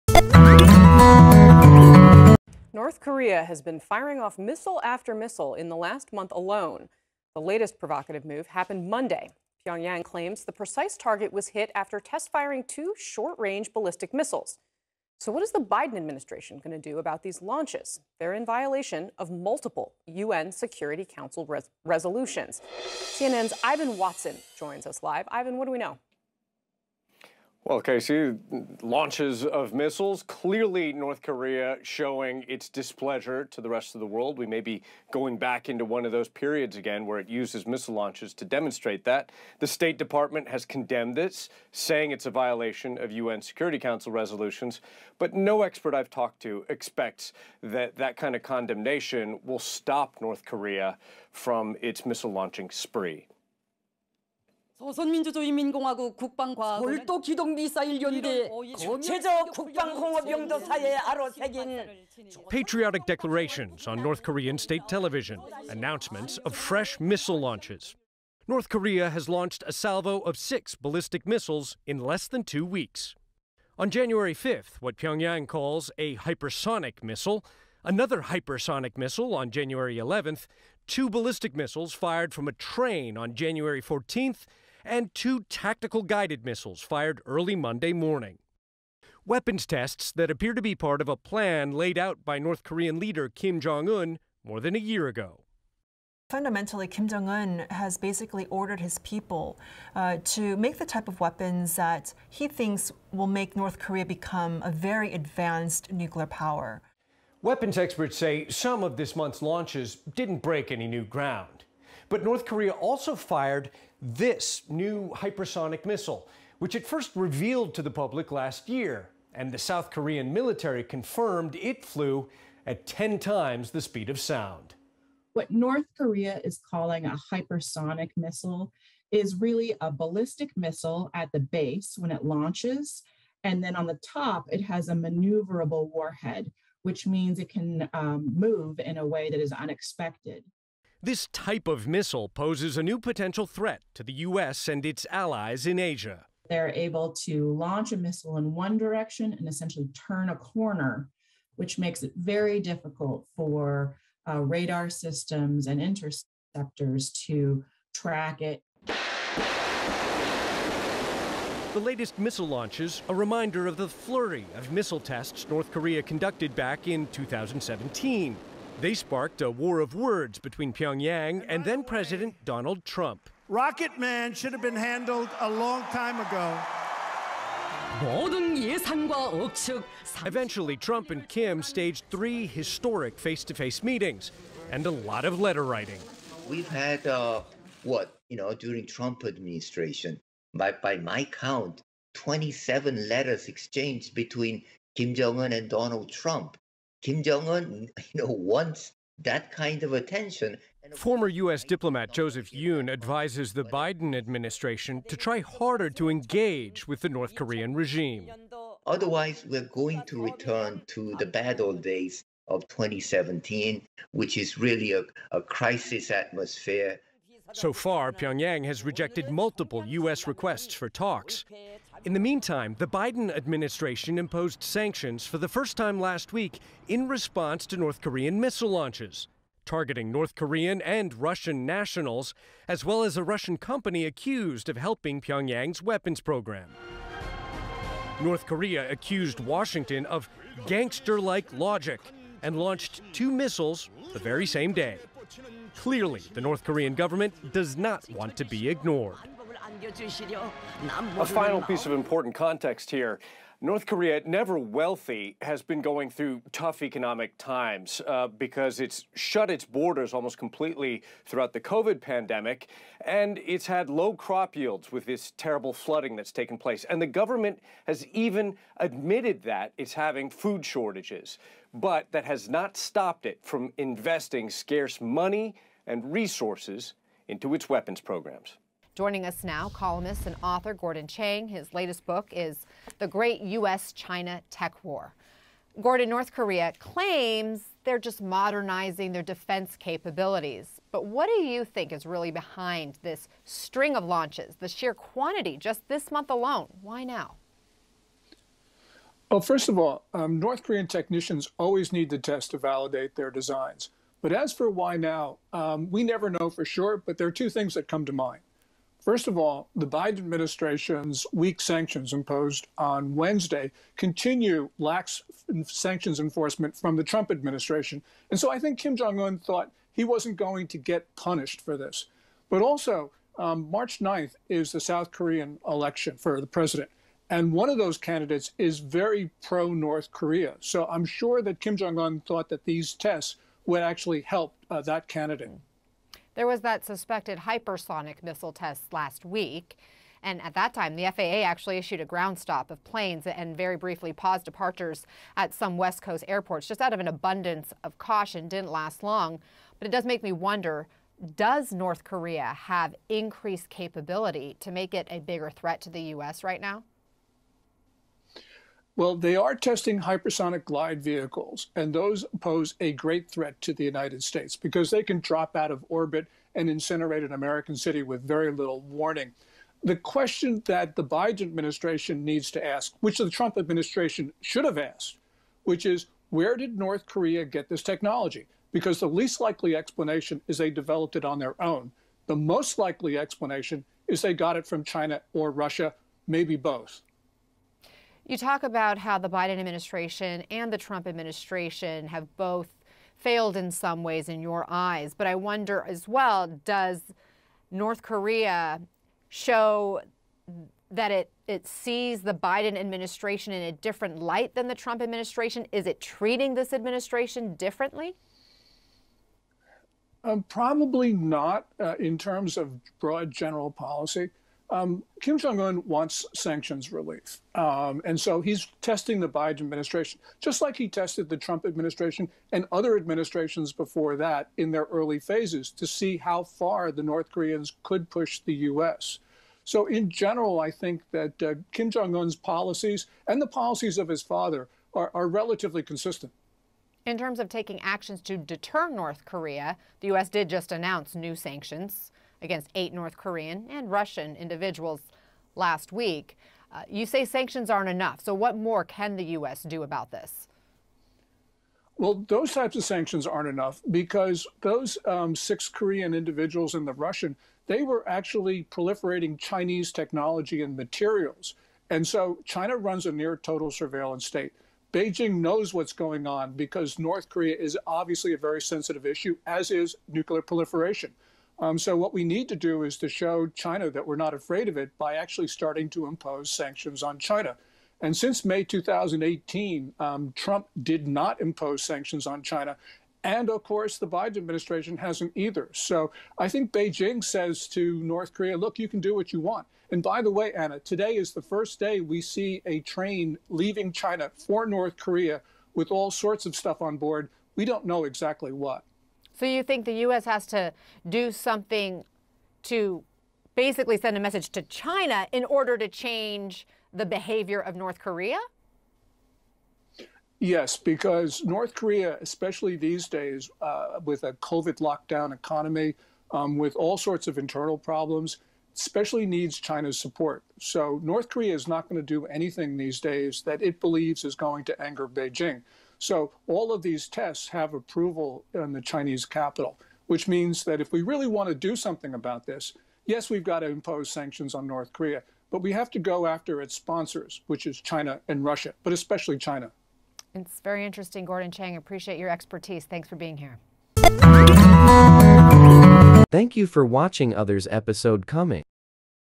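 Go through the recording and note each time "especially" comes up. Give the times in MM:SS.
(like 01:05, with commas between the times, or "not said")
08:32, 08:38, 08:58.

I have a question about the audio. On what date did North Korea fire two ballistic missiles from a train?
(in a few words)
January 14th.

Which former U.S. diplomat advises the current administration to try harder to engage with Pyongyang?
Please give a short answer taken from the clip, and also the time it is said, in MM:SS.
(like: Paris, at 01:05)
Joseph Yun, at 03:22.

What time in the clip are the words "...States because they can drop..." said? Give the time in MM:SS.
06:04.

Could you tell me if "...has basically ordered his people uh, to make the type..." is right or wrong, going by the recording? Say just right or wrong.
right.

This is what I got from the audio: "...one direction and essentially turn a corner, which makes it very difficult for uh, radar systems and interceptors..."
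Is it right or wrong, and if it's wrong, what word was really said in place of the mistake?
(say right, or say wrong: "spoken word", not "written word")
right.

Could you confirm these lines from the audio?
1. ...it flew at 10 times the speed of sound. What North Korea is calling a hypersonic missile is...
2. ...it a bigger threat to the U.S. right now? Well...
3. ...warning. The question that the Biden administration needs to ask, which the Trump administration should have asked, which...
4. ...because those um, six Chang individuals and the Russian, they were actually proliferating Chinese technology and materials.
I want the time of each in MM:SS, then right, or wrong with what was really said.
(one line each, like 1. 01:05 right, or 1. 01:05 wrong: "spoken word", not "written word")
1. 02:01 right
2. 05:54 right
3. 06:08 right
4. 07:33 wrong: "Korean", not "Chang".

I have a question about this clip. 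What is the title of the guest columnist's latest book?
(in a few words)
The Great U.S. China Tech War.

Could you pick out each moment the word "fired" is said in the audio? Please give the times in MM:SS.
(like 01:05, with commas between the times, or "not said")
01:21, 01:26, 01:53.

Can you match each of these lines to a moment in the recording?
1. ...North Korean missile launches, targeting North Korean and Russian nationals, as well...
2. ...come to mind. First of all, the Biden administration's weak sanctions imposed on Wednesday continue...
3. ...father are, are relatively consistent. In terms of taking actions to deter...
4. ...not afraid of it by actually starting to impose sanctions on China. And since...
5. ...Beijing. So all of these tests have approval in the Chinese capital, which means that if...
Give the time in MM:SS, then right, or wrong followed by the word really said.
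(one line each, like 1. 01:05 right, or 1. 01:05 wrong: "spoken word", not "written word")
1. 03:47 right
2. 05:07 right
3. 07:14 right
4. 07:54 right
5. 08:45 right.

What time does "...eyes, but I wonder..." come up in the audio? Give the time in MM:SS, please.
06:34.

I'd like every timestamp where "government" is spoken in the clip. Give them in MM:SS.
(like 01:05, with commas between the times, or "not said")
04:06, 04:27.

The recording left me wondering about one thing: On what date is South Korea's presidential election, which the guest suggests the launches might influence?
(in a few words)
March 9th.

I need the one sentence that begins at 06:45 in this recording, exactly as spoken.
Is it treating this administration differently?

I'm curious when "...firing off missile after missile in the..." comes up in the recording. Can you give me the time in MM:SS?
00:03.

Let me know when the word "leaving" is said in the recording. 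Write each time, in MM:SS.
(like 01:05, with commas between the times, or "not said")
08:13.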